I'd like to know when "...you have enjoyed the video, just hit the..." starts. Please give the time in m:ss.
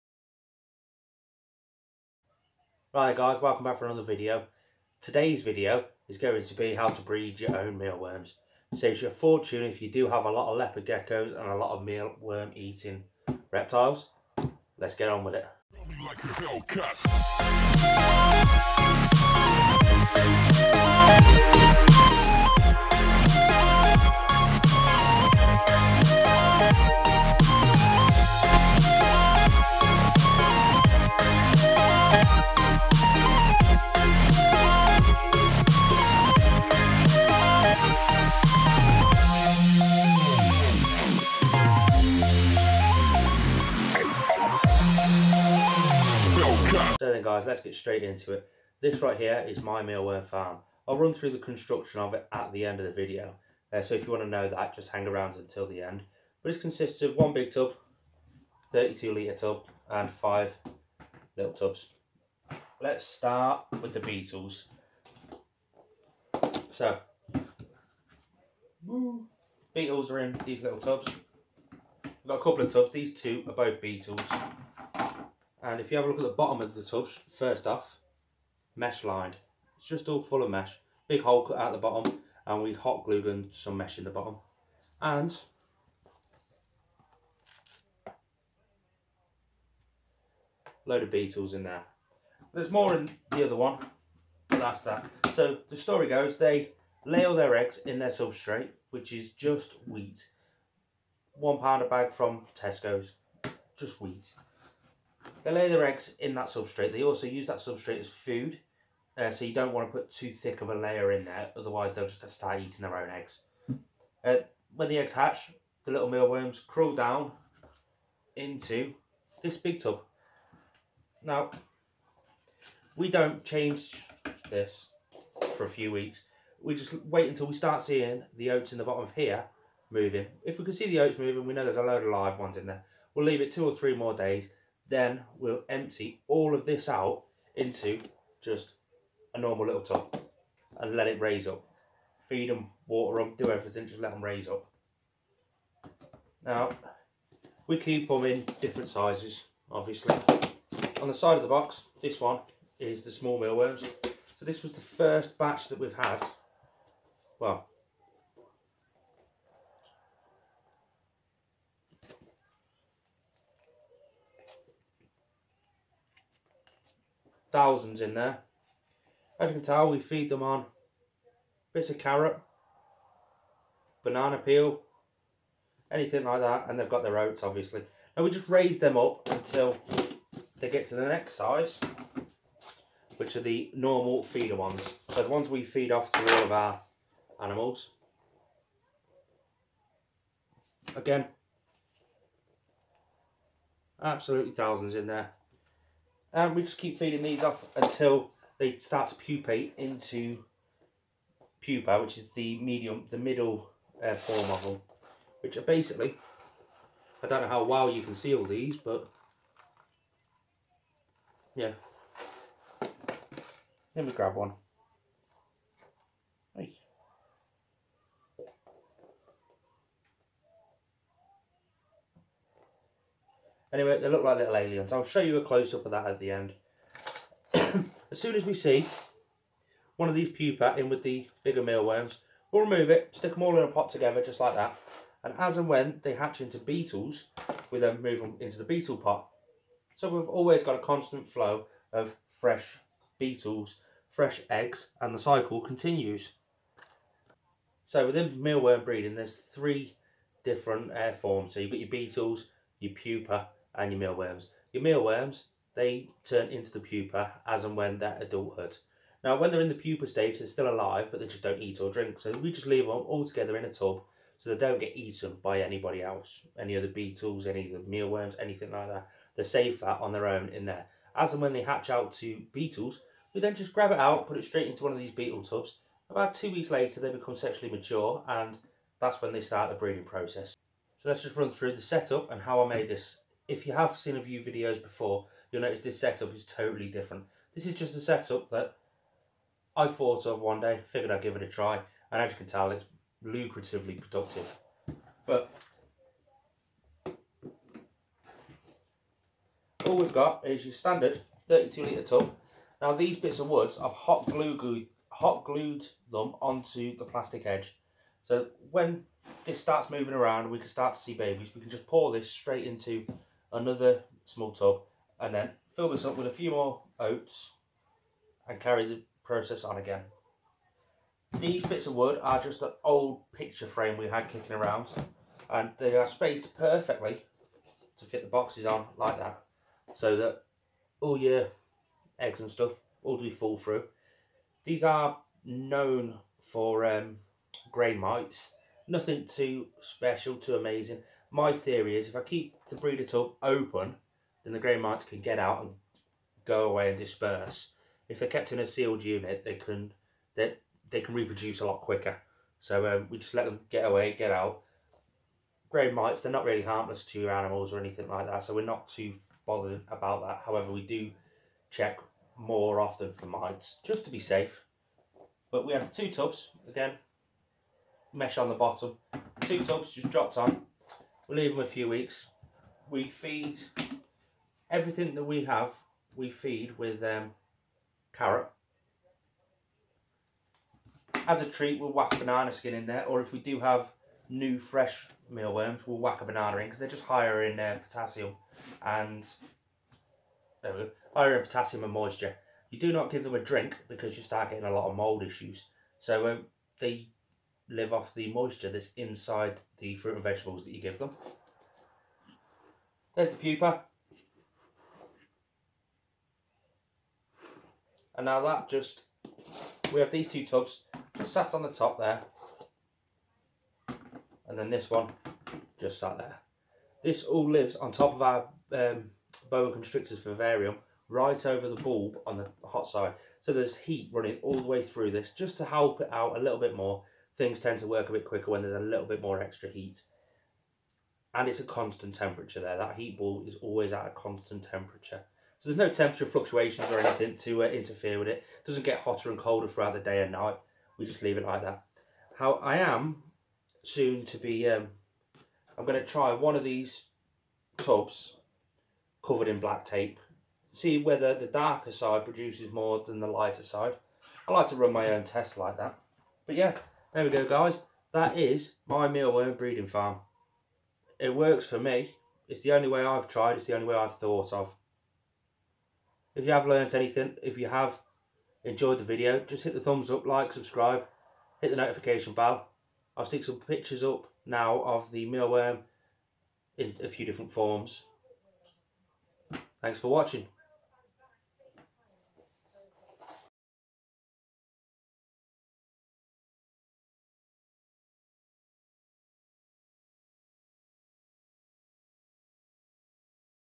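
7:47.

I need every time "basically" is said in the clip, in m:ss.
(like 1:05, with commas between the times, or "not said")
3:25.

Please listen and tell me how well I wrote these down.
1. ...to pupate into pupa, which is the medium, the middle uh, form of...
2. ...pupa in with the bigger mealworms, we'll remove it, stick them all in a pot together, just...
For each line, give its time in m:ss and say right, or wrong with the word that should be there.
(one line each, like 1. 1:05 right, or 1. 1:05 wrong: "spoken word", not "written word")
1. 3:19 right
2. 3:50 right.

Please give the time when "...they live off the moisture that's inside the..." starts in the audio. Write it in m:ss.
6:36.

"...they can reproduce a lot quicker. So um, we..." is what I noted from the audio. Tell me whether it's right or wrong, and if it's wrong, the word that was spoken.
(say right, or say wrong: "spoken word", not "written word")
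right.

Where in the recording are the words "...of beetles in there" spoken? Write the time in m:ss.
1:31.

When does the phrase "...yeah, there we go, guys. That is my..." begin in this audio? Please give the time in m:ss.
7:36.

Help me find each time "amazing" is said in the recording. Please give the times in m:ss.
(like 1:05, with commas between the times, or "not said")
5:40.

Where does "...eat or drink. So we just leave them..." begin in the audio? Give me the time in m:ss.
4:21.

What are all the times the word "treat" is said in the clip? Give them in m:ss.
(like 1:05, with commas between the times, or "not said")
6:21.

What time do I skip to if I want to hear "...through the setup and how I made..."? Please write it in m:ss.
4:41.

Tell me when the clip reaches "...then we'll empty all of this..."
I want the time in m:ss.
2:14.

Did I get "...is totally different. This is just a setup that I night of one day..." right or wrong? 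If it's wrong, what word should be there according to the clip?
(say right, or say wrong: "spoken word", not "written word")
wrong: "thought", not "night".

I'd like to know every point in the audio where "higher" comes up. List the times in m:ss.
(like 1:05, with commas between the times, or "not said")
6:27, 6:31.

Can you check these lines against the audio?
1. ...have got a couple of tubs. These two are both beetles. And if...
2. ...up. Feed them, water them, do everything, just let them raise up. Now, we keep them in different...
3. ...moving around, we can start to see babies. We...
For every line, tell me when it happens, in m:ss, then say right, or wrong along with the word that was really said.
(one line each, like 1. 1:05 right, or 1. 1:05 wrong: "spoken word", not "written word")
1. 1:12 right
2. 2:21 right
3. 5:09 right.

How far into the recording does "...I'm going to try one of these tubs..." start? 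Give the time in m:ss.
7:25.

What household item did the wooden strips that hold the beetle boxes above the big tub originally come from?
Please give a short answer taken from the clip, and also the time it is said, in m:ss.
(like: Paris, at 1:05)
An old picture frame, at 5:22.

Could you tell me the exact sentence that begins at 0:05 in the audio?
Today's video is going to be how to breed your own mealworms.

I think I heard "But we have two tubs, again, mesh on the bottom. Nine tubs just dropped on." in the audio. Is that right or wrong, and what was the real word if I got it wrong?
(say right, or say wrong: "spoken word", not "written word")
wrong: "Two", not "Nine".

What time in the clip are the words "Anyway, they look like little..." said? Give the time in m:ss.
3:43.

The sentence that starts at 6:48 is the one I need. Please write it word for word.
And now that just, we have these two tubs just sat on the top there.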